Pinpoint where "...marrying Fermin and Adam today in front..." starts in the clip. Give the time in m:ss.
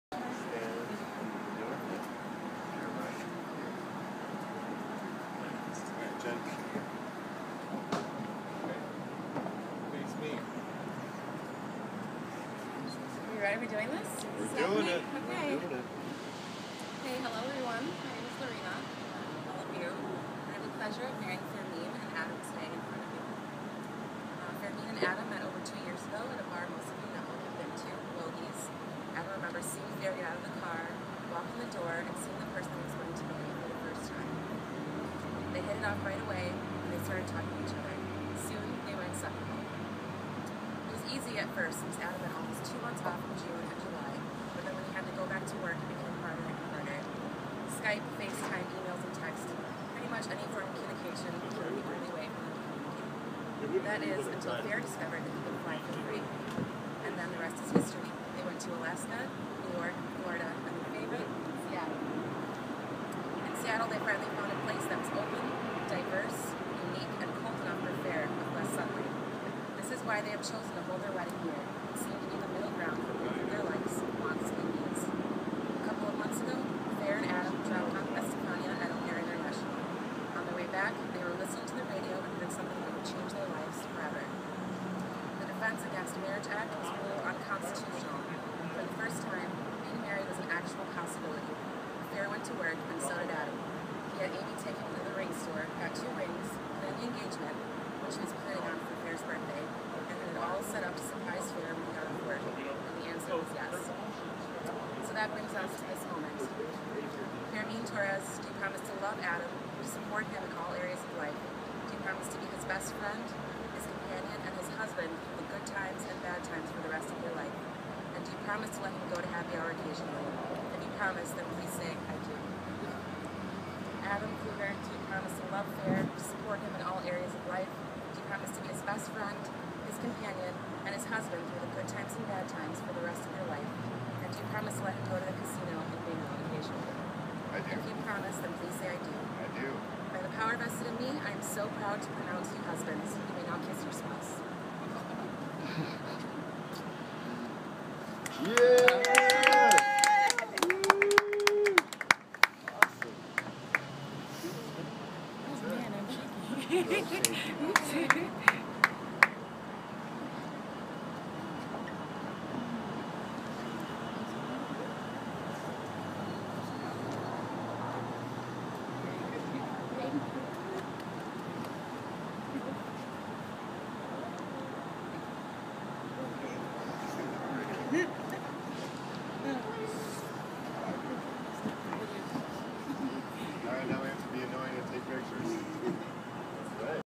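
0:21.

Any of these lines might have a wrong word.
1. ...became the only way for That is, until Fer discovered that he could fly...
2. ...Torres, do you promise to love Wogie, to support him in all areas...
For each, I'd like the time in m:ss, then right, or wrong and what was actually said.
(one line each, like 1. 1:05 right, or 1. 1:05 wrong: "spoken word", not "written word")
1. 0:51 right
2. 1:47 wrong: "Adam", not "Wogie".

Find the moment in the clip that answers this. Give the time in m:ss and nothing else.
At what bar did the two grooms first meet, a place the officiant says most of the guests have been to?
0:28.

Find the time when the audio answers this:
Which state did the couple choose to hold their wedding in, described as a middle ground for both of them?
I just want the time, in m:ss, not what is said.
0:58.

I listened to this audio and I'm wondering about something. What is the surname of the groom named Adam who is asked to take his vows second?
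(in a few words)
Kluger.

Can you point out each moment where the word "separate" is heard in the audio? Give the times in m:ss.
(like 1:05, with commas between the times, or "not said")
0:39.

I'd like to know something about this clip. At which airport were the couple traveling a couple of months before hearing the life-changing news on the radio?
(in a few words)
O'Hare International.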